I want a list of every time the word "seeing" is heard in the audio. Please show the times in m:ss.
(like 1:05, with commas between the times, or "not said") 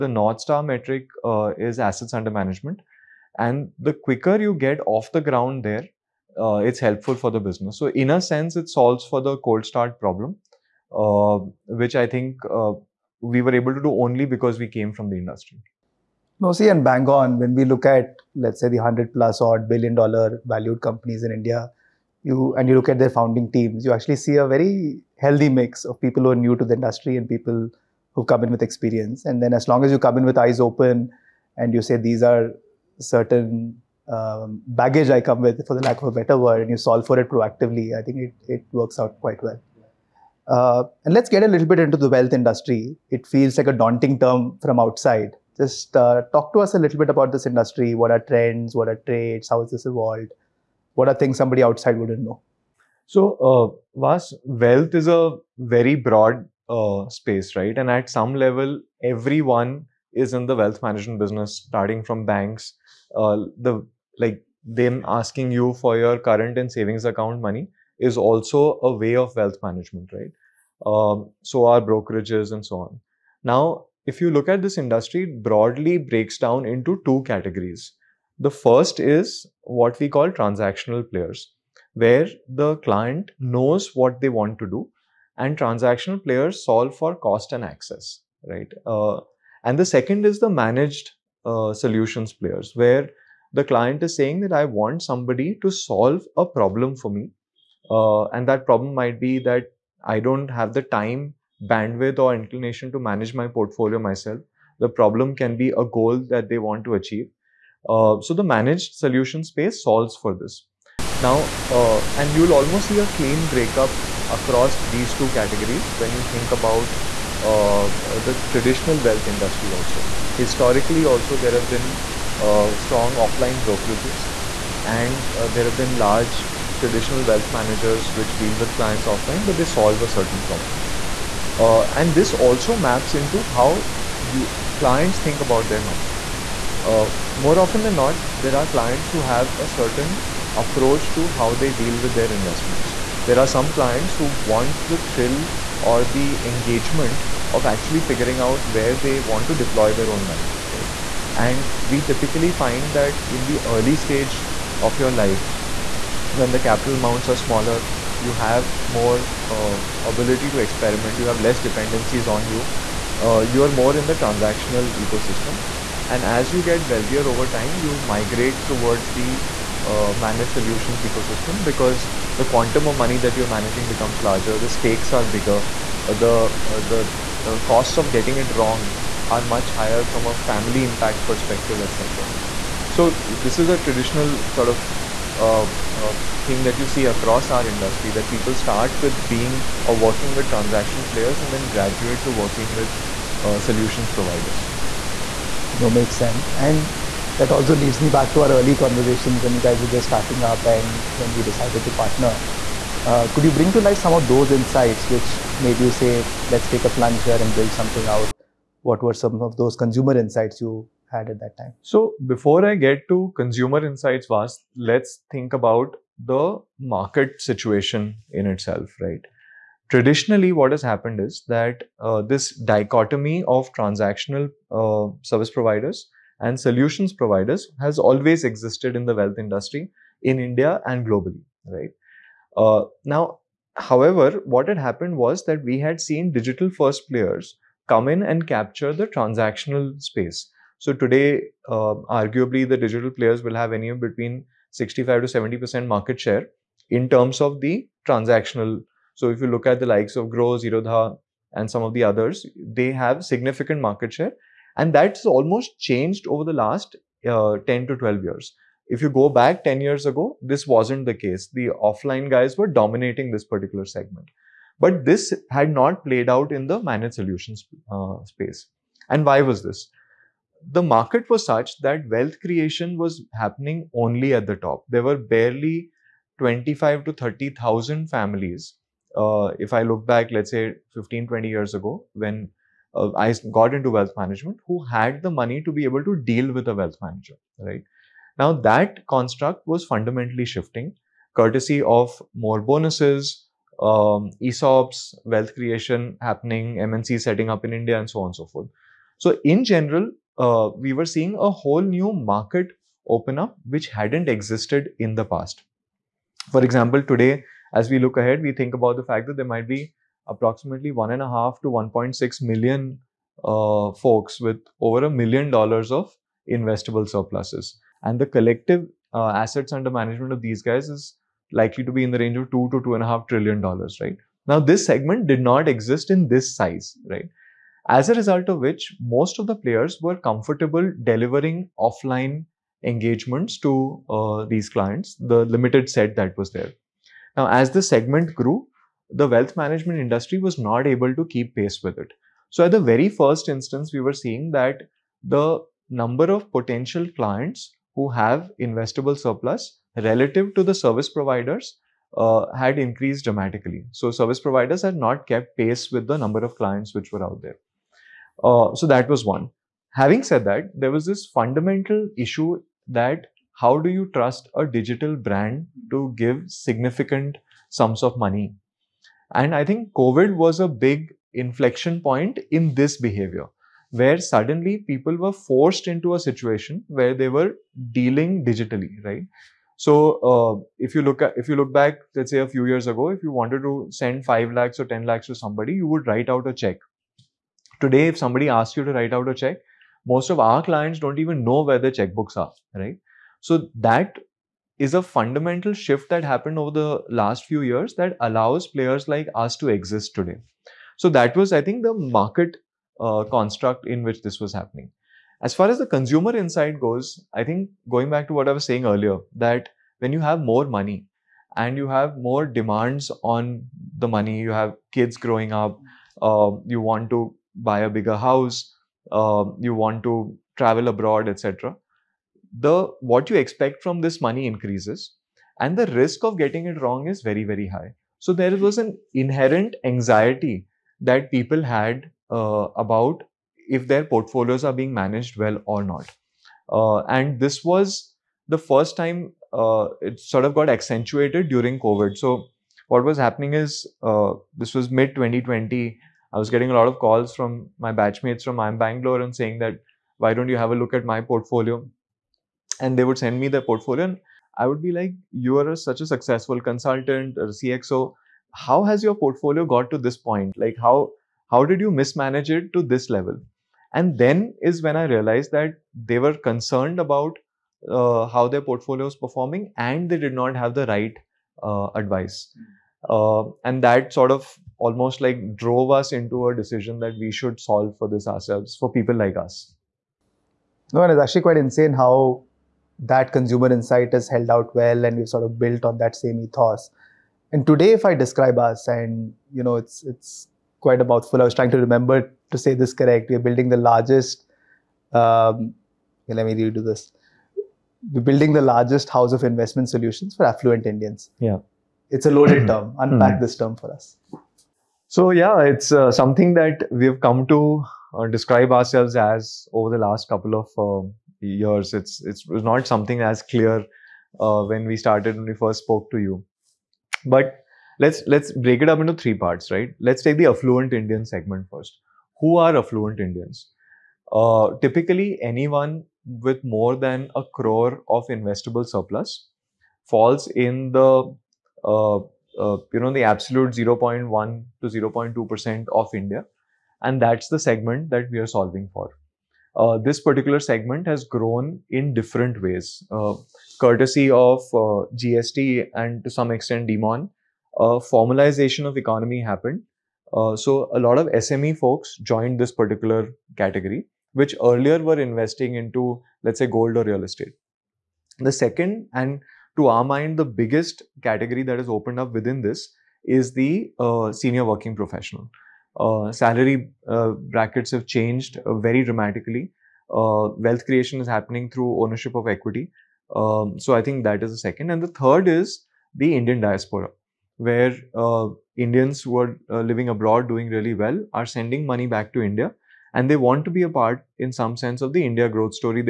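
5:01, 5:44.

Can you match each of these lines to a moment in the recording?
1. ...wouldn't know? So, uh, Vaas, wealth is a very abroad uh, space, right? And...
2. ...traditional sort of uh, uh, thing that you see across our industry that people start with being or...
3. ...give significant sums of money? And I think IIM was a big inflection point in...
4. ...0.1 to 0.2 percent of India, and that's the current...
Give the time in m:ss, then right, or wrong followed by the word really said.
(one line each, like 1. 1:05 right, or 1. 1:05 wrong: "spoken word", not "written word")
1. 0:51 wrong: "broad", not "abroad"
2. 3:03 right
3. 6:06 wrong: "COVID", not "IIM"
4. 8:53 wrong: "segment", not "current".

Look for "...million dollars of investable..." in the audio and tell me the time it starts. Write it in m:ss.
5:15.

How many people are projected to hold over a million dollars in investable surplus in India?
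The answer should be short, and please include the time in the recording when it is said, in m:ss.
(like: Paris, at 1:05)
1.5 to 1.6 million, at 5:10.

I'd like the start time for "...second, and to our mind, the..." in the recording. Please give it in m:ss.
9:18.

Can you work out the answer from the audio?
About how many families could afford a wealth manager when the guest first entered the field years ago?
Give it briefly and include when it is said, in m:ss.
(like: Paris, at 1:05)
25,000 to 30,000, at 4:36.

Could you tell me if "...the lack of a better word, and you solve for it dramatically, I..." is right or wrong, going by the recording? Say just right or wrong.
wrong.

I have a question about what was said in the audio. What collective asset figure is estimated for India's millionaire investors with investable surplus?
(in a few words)
2 to 2.5 trillion dollars.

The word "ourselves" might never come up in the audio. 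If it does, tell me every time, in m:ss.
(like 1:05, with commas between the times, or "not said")
7:58, 8:28.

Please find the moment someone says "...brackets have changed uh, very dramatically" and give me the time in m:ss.
9:27.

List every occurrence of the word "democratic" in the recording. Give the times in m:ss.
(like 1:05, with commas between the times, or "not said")
not said.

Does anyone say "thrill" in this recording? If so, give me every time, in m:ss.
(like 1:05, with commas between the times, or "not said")
2:24.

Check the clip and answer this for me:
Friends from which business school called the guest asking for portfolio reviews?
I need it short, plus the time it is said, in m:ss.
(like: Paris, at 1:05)
IIM Bangalore, at 7:28.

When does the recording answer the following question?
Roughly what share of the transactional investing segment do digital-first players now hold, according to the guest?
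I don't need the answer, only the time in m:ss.
4:04.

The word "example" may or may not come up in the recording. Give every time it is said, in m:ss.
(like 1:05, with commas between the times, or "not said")
5:06.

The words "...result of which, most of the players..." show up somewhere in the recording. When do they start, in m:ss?
5:28.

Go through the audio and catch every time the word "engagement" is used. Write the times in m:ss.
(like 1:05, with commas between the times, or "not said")
2:26, 5:32.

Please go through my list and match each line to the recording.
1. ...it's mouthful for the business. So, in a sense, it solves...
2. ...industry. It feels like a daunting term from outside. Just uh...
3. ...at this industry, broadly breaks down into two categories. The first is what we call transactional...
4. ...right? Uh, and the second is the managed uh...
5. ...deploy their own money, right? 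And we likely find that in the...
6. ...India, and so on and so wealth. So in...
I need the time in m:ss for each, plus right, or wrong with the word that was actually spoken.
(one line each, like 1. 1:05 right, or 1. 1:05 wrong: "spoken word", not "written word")
1. 0:06 wrong: "helpful", not "mouthful"
2. 0:42 right
3. 1:14 right
4. 1:28 right
5. 2:29 wrong: "typically", not "likely"
6. 4:57 wrong: "forth", not "wealth".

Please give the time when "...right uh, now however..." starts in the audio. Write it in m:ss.
3:51.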